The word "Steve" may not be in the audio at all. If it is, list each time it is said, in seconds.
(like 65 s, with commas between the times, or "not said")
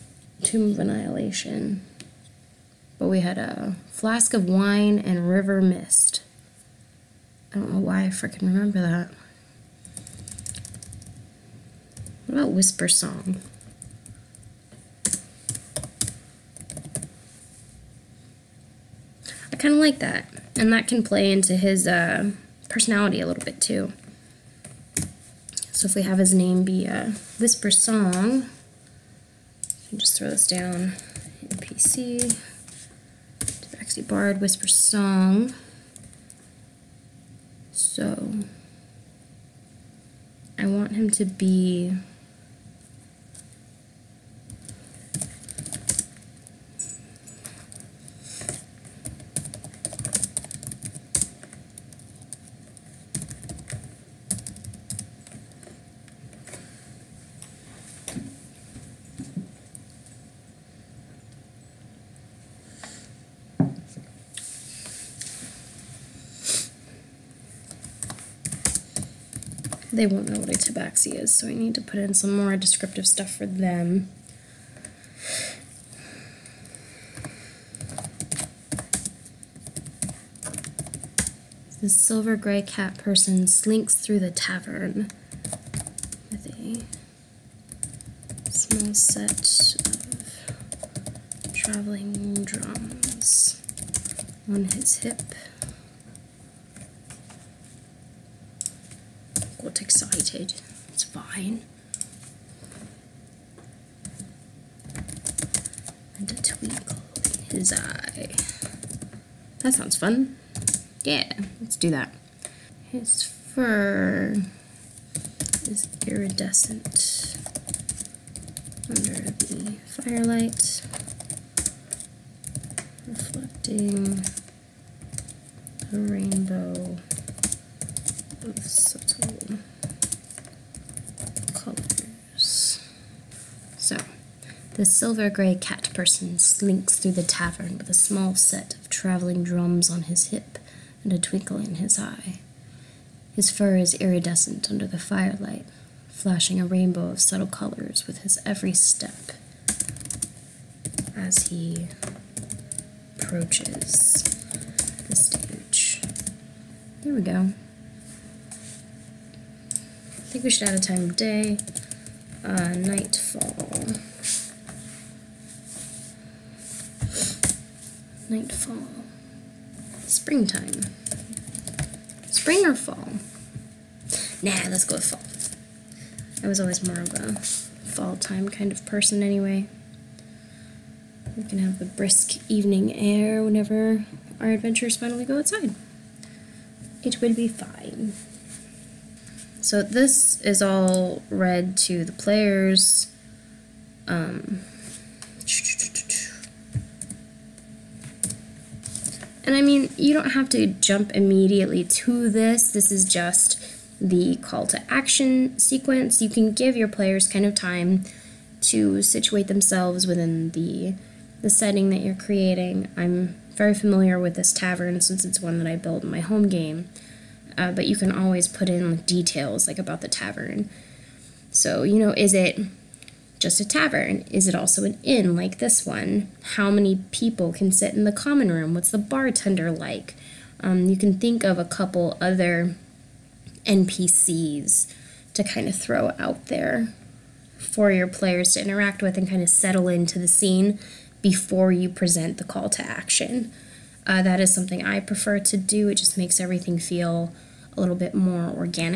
not said.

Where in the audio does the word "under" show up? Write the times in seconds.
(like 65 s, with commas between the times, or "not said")
118 s, 144 s.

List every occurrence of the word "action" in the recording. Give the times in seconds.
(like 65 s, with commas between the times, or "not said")
204 s, 242 s.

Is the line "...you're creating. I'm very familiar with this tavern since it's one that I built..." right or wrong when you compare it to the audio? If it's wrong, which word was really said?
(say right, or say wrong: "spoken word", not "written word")
right.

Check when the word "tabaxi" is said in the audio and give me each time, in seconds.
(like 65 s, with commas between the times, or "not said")
33 s, 70 s.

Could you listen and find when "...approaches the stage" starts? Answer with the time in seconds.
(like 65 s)
153 s.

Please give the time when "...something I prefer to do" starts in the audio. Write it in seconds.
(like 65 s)
244 s.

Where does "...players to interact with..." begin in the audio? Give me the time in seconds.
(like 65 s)
238 s.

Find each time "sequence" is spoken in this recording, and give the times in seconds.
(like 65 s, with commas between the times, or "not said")
205 s.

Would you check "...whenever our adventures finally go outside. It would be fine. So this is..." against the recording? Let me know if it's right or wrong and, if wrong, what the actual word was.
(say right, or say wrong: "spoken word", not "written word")
right.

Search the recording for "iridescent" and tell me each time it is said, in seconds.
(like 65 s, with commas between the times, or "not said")
116 s, 143 s.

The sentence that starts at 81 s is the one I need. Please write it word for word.
The silver gray cat person slinks through the tavern with a small set of traveling drums on his hip.